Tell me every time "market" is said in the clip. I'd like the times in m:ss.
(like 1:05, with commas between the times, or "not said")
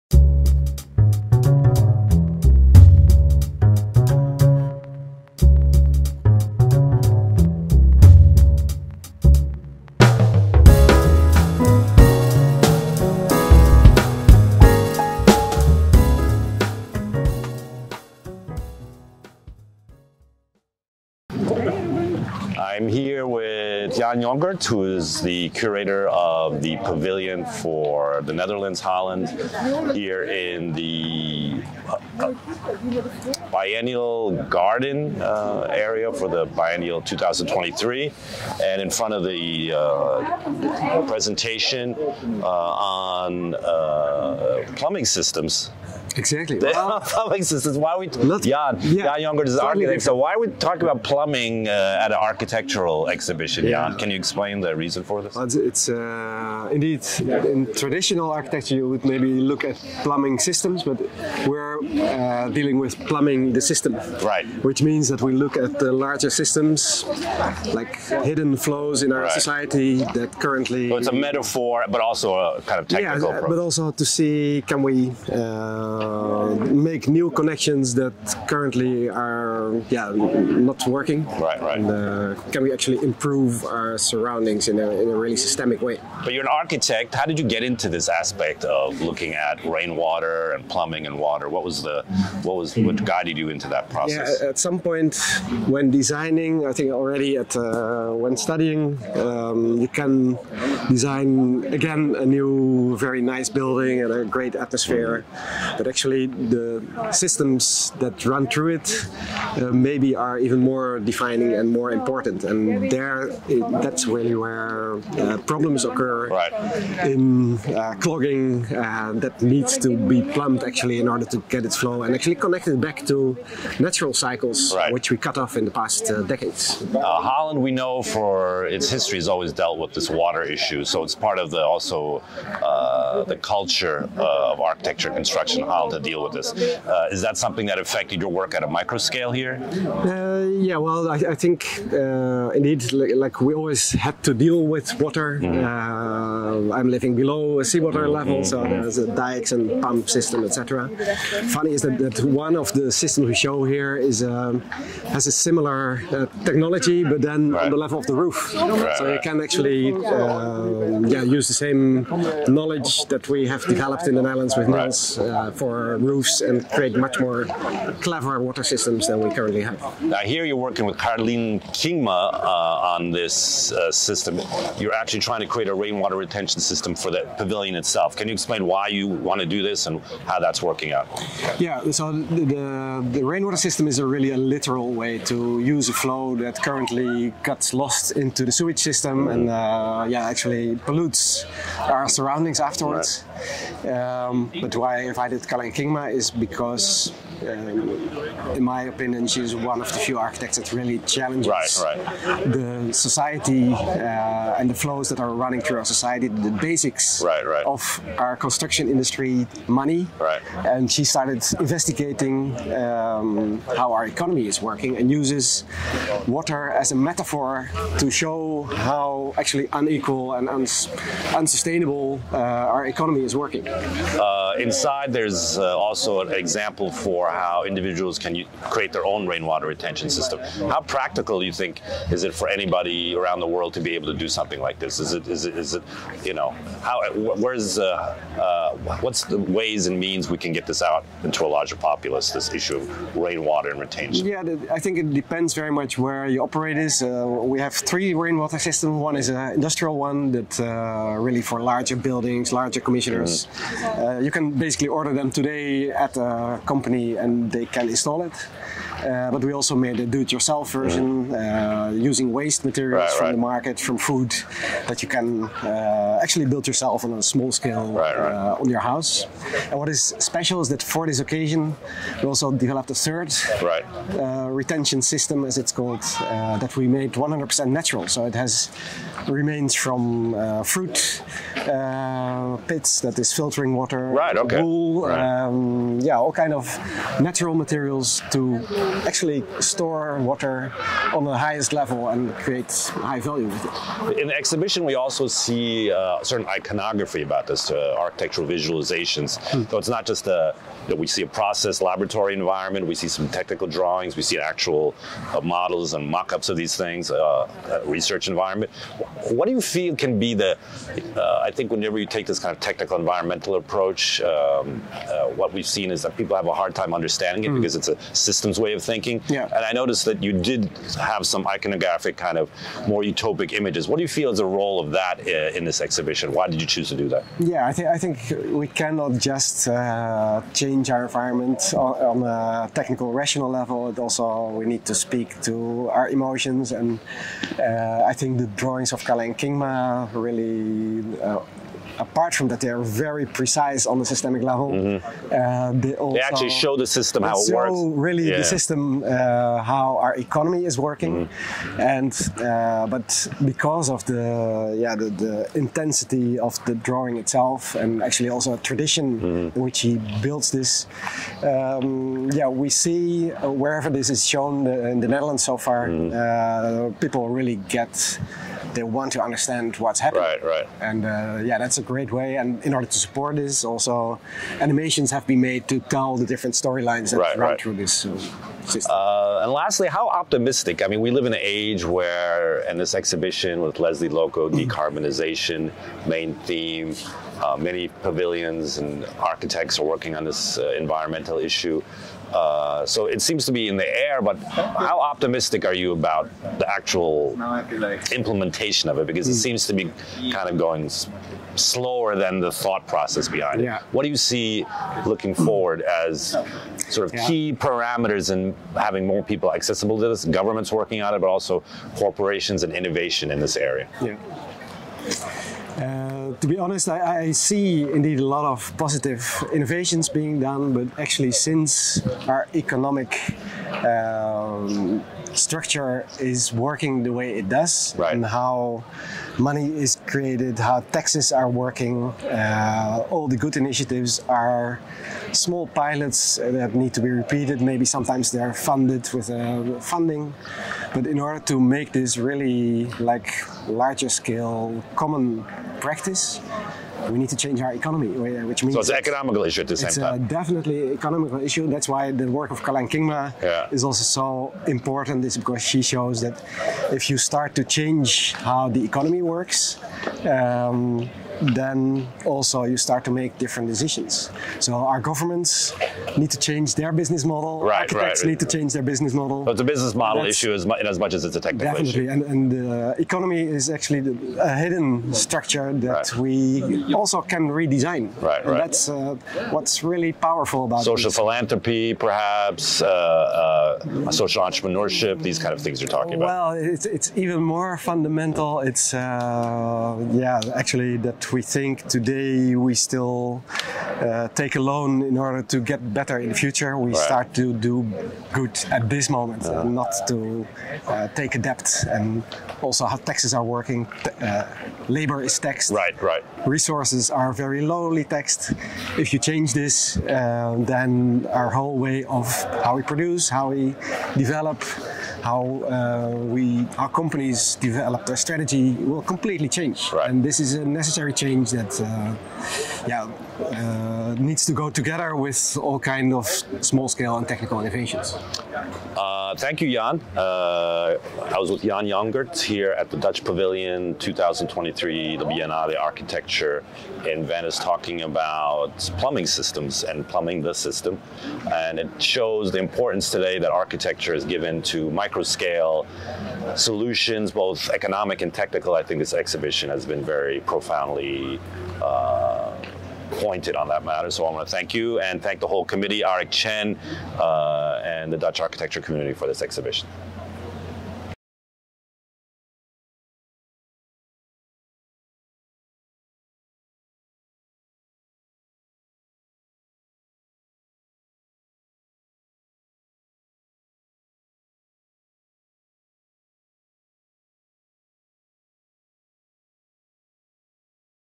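4:23.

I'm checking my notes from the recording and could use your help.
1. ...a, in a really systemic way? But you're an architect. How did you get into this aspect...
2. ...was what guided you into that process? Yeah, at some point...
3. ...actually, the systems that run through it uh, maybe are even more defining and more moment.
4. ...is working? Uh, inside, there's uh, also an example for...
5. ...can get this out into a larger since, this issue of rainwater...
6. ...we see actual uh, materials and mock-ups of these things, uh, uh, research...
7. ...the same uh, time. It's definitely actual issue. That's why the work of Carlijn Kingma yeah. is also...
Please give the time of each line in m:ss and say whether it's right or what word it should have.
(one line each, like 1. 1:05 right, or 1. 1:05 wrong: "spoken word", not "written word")
1. 1:24 right
2. 1:32 right
3. 1:45 wrong: "important", not "moment"
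4. 3:43 right
5. 4:00 wrong: "populace", not "since"
6. 5:04 wrong: "models", not "materials"
7. 7:29 wrong: "economical", not "actual".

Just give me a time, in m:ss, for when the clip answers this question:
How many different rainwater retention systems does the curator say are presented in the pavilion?
4:07.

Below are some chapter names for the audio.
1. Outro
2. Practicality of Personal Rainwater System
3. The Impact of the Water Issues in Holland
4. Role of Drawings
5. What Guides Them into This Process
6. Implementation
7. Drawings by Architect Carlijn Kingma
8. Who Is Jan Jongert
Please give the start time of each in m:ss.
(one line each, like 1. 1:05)
1. 9:20
2. 3:43
3. 2:06
4. 4:53
5. 1:25
6. 6:18
7. 2:49
8. 0:21.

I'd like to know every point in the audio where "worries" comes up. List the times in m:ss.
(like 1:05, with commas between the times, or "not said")
not said.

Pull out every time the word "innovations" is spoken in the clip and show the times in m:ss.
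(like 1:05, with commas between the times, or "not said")
6:52, 6:59, 8:47.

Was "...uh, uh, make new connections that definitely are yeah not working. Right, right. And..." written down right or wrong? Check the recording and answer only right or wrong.
wrong.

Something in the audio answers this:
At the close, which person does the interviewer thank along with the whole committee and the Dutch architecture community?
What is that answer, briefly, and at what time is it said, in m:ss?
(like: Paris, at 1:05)
Aric Chen, at 9:16.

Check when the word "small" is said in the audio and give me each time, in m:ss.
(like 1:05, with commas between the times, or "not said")
4:27, 7:15, 8:46.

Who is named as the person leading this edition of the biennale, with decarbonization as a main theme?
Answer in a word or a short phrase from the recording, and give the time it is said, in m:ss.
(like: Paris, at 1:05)
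Lesley Lokko, at 6:23.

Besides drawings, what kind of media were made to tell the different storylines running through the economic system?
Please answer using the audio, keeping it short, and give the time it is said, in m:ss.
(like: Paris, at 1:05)
animations, at 6:14.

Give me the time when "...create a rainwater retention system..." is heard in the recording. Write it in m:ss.
2:55.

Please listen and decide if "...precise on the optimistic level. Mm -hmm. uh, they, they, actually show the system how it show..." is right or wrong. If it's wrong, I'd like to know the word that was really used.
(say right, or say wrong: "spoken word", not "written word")
wrong: "systemic", not "optimistic".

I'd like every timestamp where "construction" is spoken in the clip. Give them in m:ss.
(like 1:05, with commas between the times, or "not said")
2:15, 3:28.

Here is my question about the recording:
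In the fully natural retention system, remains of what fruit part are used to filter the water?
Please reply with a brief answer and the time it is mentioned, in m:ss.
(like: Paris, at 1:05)
fruit pits, at 4:40.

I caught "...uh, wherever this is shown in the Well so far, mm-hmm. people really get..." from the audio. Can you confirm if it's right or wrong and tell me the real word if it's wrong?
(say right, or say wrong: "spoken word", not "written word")
wrong: "Netherlands", not "Well".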